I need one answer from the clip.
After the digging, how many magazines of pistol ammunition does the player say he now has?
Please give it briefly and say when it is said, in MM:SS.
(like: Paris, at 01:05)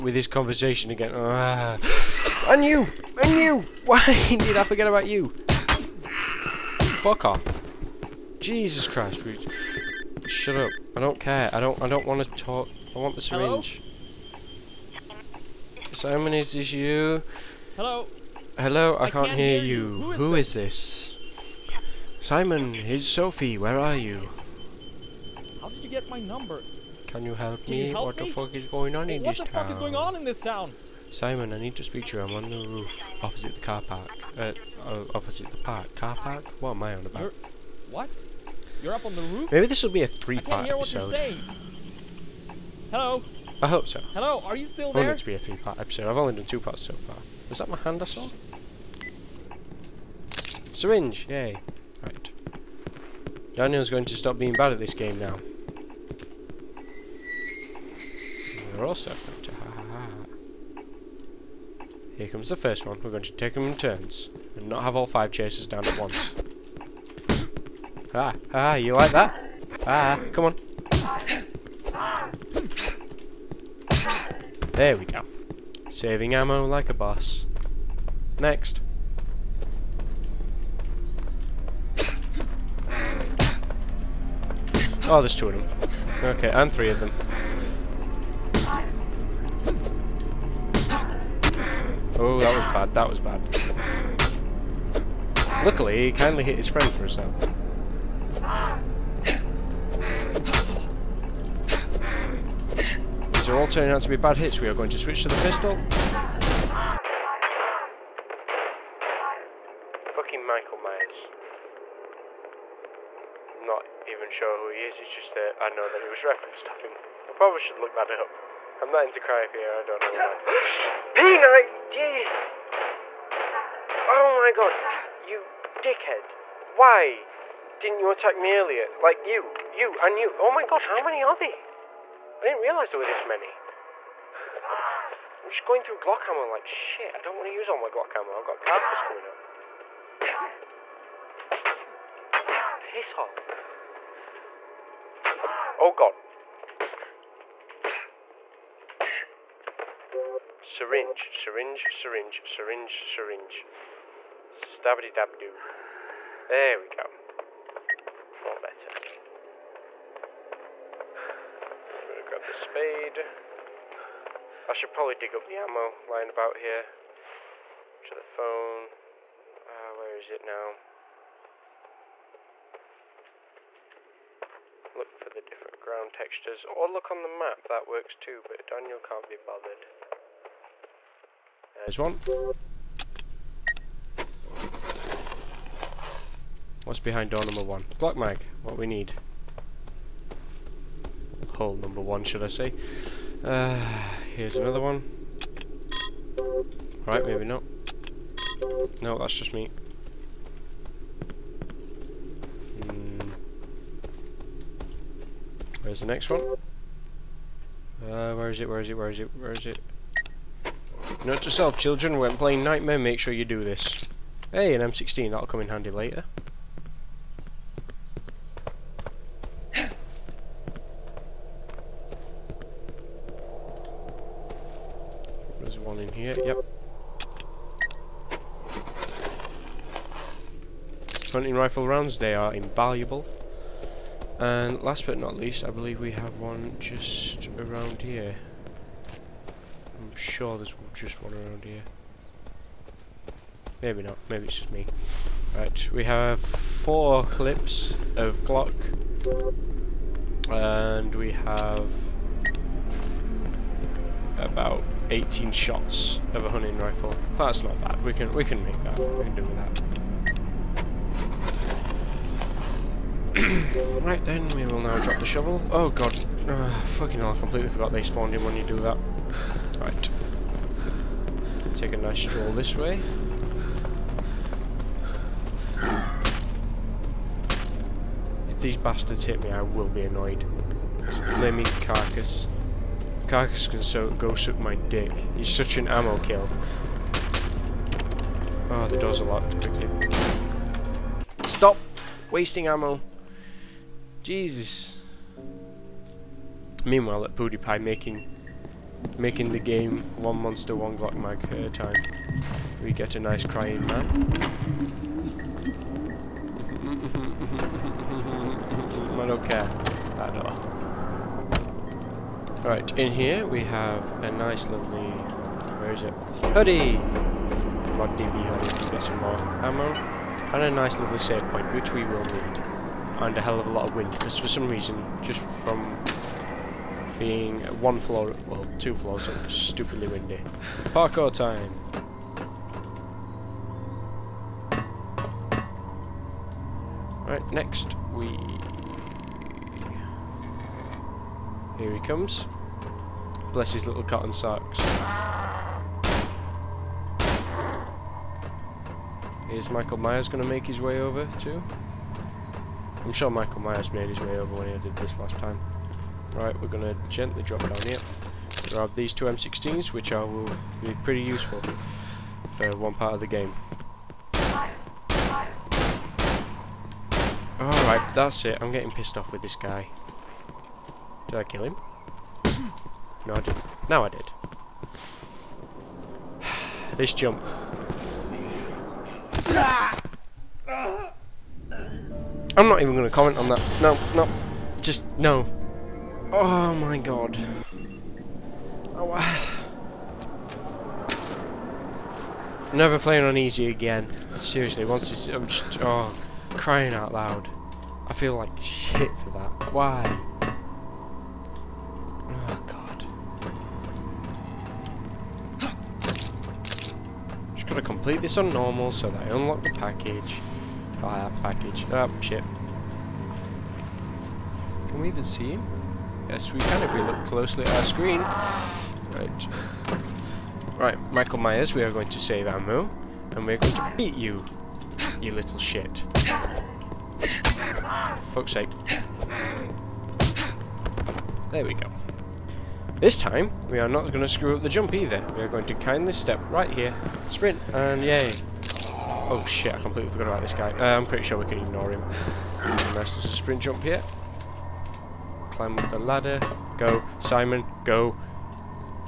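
4, at 04:06.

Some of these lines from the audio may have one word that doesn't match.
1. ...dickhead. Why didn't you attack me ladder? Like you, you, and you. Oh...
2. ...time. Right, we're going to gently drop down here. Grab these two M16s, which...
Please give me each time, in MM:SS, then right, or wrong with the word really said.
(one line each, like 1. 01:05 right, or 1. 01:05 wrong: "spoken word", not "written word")
1. 02:05 wrong: "earlier", not "ladder"
2. 05:55 right.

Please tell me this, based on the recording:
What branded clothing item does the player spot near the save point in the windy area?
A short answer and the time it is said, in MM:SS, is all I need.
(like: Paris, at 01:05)
Mod DB hoodie, at 05:17.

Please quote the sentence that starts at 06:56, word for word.
Yes, we can if we look closely at our screen.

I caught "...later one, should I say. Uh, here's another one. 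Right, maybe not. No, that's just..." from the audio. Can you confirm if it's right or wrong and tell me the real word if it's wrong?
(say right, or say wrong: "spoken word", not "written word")
wrong: "number", not "later".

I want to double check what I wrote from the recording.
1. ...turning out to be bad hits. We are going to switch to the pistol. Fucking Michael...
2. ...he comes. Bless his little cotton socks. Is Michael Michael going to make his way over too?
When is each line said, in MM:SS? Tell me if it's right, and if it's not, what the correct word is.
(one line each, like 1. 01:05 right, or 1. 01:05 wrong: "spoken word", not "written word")
1. 01:43 right
2. 05:41 wrong: "Myers", not "Michael".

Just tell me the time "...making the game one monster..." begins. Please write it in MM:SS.
04:59.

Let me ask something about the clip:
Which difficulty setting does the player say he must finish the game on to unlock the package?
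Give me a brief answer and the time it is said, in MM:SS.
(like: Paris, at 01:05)
Normal, at 06:48.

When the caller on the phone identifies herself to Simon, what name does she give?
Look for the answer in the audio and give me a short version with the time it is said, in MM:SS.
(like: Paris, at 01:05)
Sophie, at 00:23.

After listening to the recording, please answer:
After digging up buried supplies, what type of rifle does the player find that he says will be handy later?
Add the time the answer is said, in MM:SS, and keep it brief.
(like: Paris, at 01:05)
M16, at 03:34.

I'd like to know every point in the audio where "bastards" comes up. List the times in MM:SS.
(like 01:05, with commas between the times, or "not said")
04:38.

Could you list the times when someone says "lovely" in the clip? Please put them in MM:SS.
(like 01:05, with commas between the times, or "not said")
05:14, 05:20.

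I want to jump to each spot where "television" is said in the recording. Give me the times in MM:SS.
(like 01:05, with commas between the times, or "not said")
not said.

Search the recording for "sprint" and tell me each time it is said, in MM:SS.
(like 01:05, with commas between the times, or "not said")
07:17, 07:23.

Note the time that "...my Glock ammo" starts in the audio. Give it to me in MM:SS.
02:17.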